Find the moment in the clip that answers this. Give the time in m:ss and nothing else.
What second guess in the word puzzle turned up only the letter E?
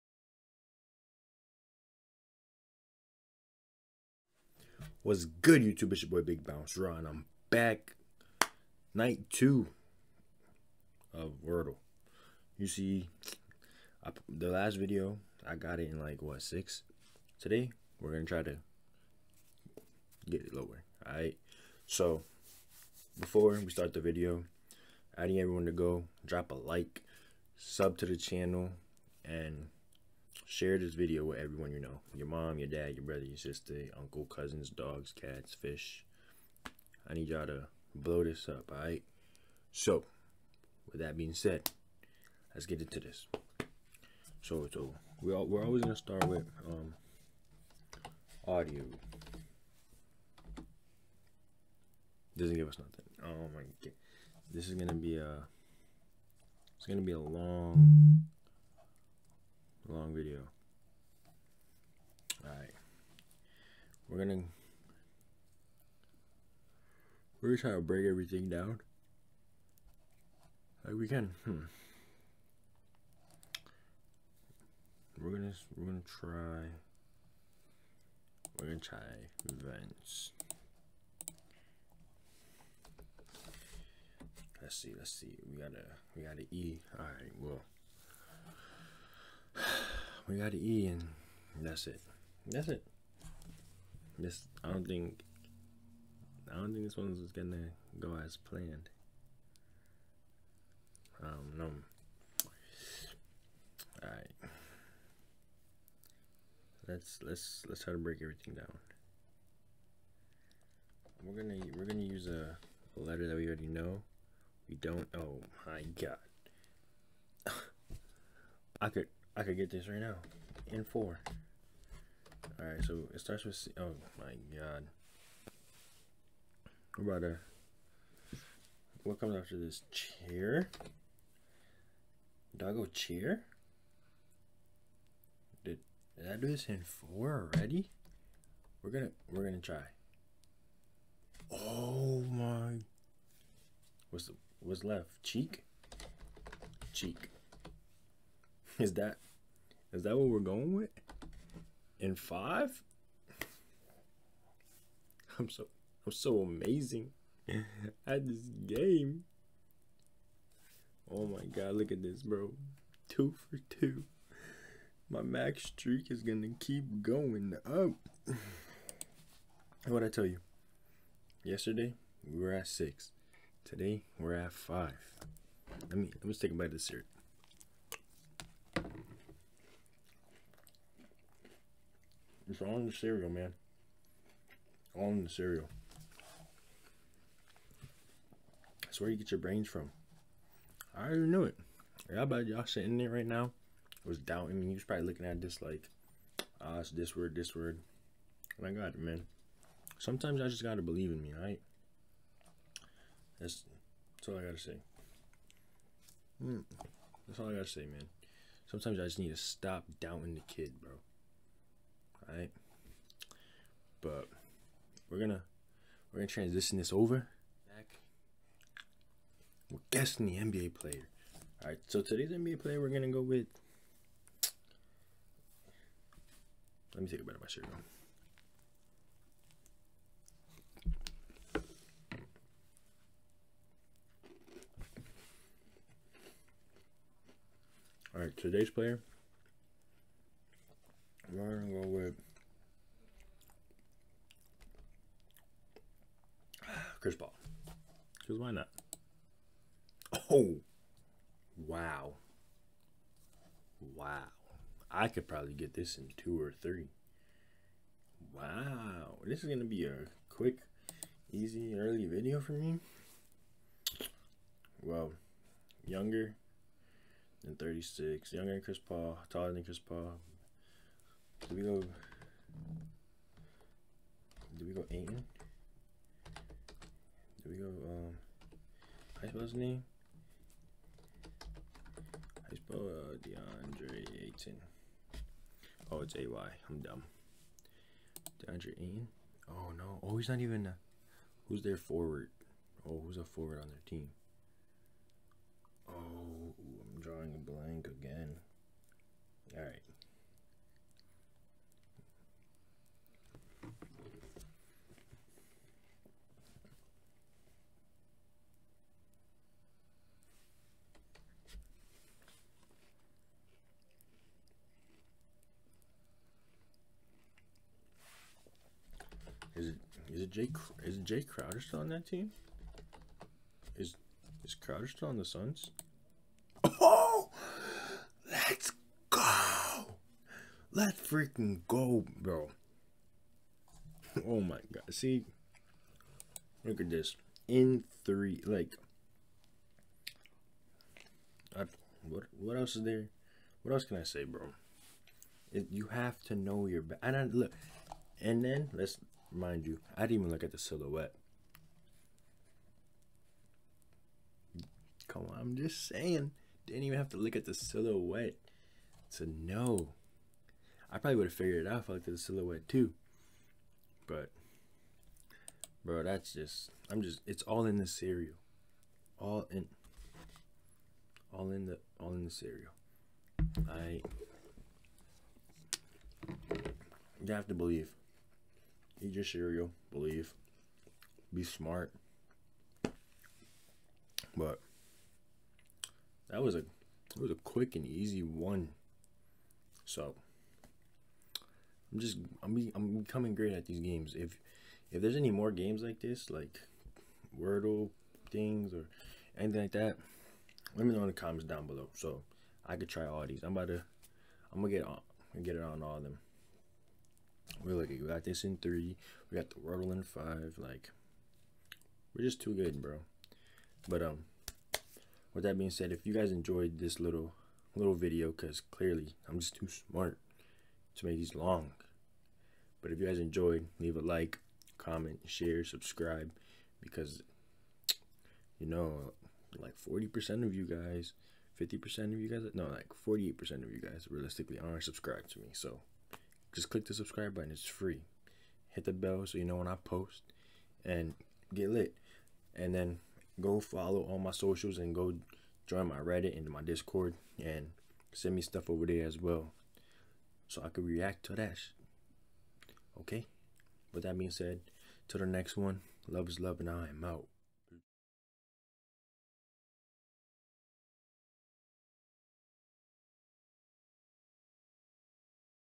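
1:19.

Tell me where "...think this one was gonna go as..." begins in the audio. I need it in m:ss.
1:36.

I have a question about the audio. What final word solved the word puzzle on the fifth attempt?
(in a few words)
cheek.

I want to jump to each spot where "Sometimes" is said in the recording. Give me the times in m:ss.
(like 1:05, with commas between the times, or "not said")
3:19, 3:28.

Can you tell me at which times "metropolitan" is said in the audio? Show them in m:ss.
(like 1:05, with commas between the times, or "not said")
not said.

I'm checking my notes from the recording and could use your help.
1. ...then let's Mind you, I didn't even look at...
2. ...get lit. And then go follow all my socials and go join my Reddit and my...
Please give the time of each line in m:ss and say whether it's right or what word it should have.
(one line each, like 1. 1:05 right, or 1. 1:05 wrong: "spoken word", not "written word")
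1. 5:48 right
2. 7:21 right.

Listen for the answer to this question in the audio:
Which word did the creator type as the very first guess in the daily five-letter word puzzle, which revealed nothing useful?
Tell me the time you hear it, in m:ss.
0:48.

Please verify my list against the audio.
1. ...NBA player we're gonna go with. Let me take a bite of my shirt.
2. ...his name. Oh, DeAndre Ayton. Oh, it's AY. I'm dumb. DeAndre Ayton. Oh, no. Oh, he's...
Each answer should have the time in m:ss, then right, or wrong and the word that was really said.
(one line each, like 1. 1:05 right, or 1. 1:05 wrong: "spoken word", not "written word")
1. 3:42 right
2. 4:39 right.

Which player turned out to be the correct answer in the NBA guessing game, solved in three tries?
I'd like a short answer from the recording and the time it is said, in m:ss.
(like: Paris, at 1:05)
Jae Crowder, at 5:20.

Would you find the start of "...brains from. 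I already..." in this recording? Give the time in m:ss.
3:09.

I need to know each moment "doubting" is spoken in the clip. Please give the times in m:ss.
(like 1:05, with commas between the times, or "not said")
3:14, 3:29.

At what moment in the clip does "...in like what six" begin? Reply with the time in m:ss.
0:15.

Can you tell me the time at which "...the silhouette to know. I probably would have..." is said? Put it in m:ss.
5:57.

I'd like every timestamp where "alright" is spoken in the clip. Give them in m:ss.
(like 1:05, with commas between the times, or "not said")
0:38, 1:44, 2:02, 3:32.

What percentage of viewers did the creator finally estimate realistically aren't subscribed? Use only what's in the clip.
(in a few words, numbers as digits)
48%.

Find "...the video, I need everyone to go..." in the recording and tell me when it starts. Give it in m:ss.
0:23.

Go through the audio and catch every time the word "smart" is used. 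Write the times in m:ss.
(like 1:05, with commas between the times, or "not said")
6:21, 6:59.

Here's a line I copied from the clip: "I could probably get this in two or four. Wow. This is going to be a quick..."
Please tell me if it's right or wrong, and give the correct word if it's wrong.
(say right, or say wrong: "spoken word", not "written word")
wrong: "three", not "four".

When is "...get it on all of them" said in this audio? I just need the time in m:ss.
6:45.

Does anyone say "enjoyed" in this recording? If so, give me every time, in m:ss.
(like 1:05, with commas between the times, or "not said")
6:56, 7:03.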